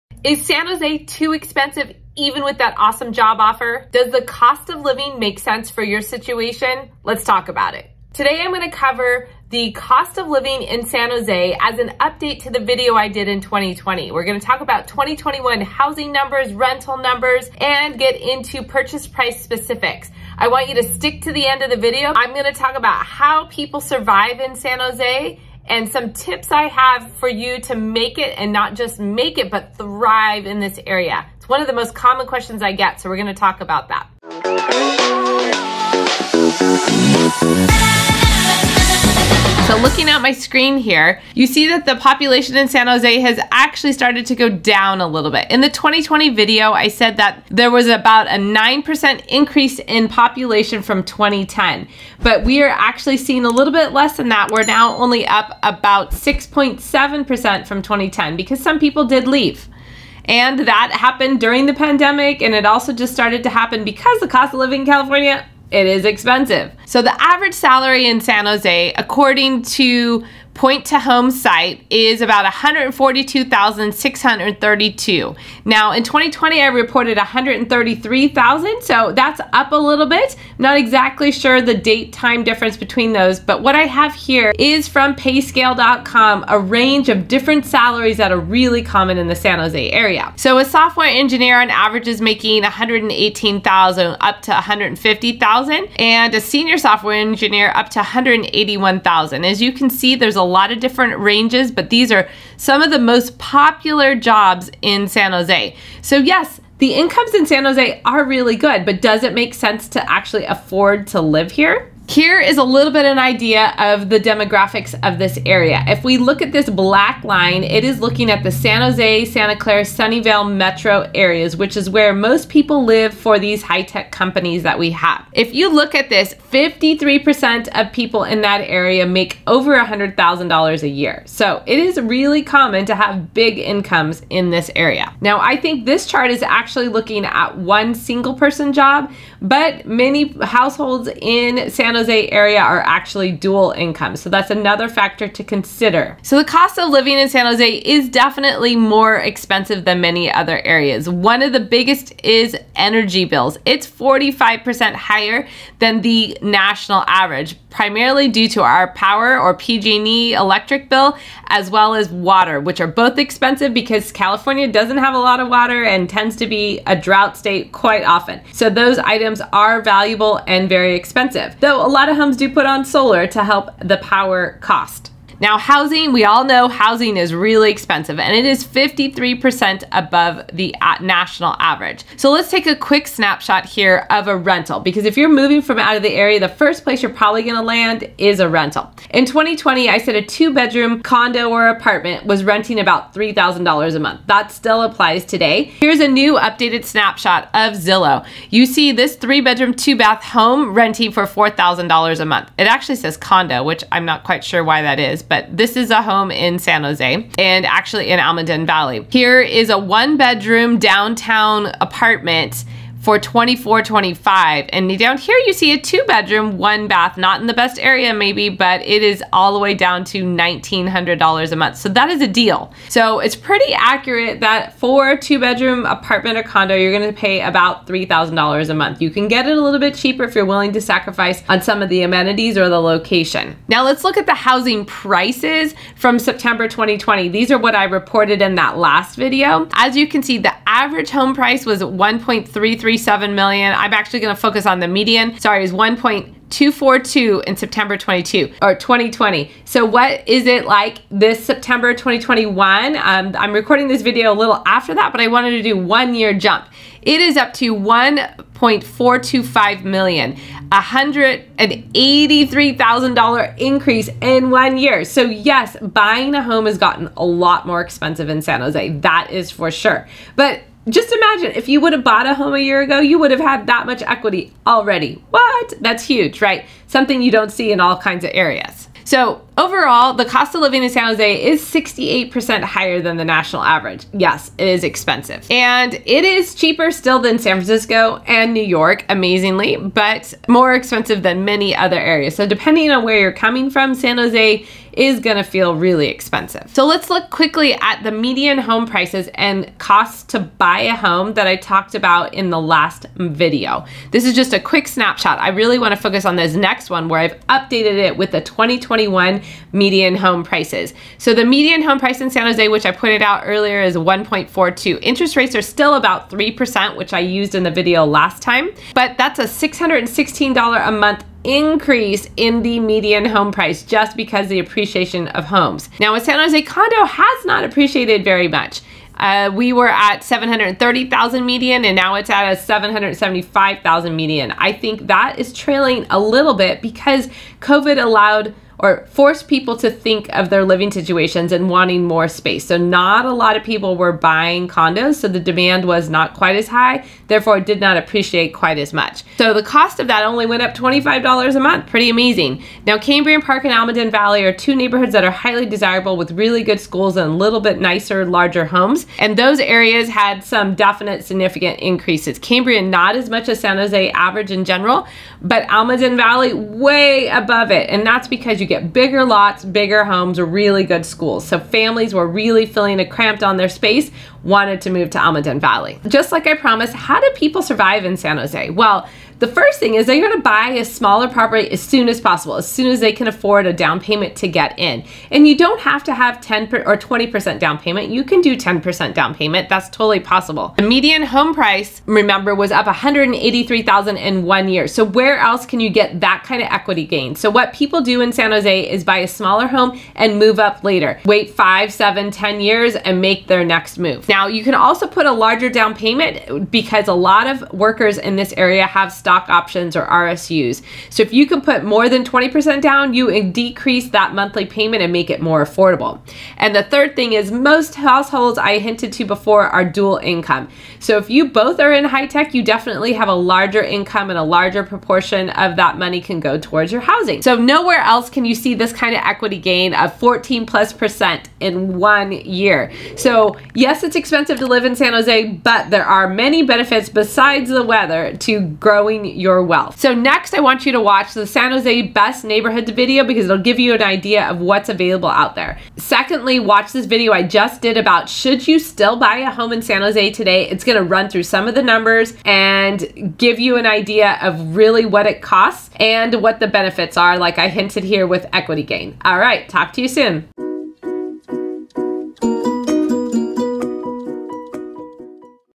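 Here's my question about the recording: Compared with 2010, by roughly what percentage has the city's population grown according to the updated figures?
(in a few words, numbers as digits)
6.7%.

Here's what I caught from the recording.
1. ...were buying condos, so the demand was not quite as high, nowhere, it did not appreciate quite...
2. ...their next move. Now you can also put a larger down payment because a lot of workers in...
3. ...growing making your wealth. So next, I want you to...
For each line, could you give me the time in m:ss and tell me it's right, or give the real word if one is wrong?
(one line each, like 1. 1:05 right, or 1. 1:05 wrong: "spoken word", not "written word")
1. 5:43 wrong: "therefore", not "nowhere"
2. 6:43 right
3. 7:18 wrong: "building", not "making".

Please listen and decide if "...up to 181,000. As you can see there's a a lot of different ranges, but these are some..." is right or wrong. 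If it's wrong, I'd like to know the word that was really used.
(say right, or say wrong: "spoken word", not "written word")
right.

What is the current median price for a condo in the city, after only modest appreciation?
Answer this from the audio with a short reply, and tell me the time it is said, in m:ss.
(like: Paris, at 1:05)
$775,000, at 5:32.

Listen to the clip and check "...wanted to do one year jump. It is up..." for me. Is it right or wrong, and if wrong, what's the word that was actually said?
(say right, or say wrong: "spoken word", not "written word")
right.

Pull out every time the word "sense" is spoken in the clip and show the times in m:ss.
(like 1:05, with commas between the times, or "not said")
0:05, 1:49.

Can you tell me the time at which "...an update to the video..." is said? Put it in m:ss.
0:11.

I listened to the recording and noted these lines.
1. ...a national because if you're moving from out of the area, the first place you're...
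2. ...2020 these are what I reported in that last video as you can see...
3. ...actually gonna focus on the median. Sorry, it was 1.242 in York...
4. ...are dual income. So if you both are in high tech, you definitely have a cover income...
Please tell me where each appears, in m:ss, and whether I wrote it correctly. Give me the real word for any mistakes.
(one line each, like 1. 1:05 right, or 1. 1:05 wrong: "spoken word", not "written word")
1. 3:04 wrong: "rental", not "national"
2. 3:56 right
3. 4:03 wrong: "September", not "York"
4. 6:59 wrong: "larger", not "cover".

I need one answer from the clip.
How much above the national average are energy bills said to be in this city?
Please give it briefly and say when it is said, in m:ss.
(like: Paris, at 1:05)
45%, at 2:33.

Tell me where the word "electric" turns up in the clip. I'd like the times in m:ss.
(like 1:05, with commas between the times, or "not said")
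2:40.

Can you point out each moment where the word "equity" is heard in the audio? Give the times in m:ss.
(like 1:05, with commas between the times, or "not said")
4:34, 6:36, 7:09, 7:38.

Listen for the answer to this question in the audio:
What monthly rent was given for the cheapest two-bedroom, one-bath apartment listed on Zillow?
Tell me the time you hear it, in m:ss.
3:40.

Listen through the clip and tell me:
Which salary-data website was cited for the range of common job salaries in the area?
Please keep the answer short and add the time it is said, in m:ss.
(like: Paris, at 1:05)
payscale.com, at 1:25.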